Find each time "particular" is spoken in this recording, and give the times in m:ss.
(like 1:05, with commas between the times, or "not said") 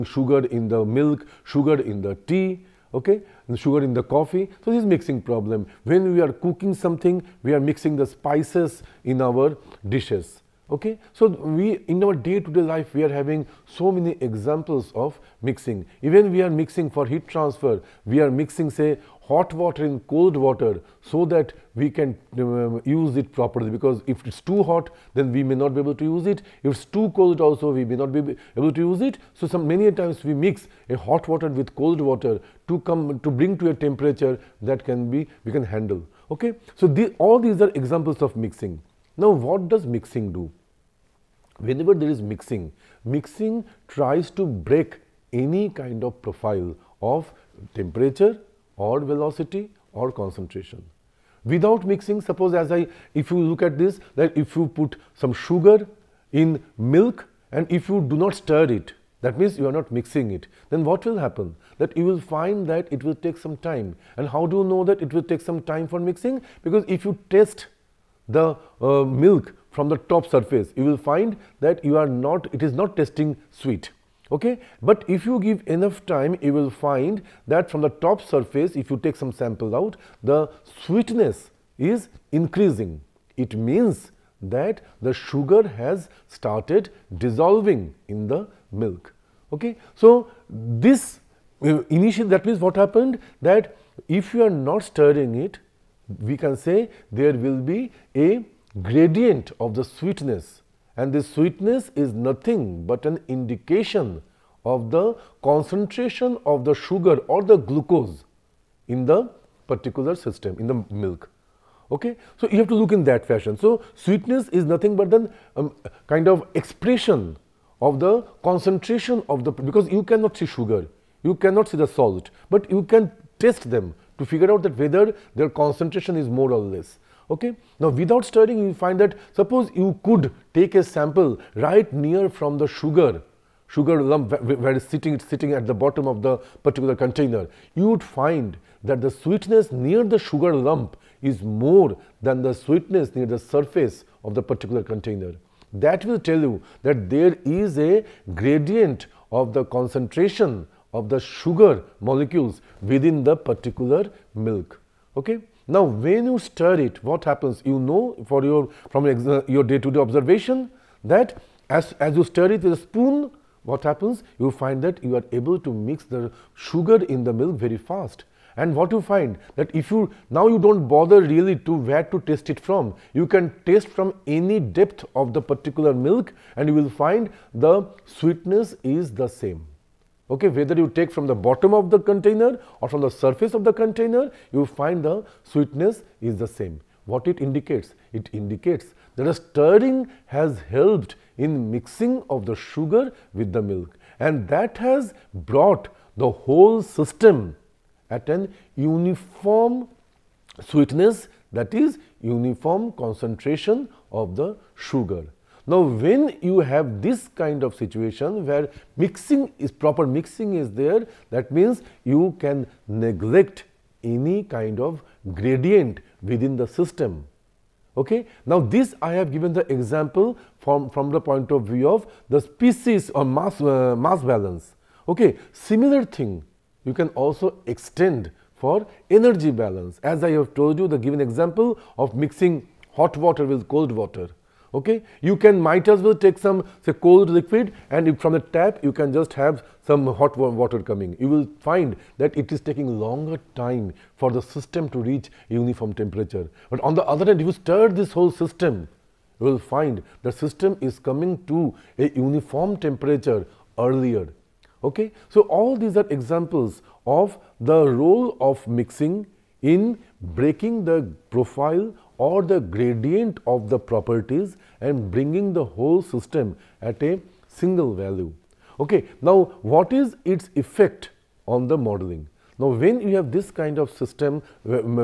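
1:49, 2:16, 2:24, 2:33, 2:55.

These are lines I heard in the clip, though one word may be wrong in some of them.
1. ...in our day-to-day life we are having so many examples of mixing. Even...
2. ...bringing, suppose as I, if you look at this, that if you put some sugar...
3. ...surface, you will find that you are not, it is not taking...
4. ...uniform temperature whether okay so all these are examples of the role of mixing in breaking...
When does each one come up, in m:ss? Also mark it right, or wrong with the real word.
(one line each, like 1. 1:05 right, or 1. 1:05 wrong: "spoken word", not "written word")
1. 0:11 right
2. 0:51 wrong: "mixing", not "bringing"
3. 1:10 wrong: "tasting", not "taking"
4. 4:12 wrong: "earlier", not "whether".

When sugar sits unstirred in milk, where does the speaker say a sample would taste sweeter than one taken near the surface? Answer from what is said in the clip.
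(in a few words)
Near the sugar lump.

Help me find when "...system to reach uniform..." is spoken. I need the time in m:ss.
4:04.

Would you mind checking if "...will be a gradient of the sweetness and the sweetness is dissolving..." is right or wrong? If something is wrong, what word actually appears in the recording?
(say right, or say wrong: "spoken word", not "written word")
wrong: "nothing", not "dissolving".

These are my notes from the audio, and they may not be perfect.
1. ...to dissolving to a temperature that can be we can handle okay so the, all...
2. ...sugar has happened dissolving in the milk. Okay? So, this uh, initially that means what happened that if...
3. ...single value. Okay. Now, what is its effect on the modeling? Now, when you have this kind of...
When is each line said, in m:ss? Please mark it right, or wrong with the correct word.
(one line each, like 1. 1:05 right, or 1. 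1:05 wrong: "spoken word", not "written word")
1. 0:33 wrong: "bring", not "dissolving"
2. 1:25 wrong: "started", not "happened"
3. 4:27 right.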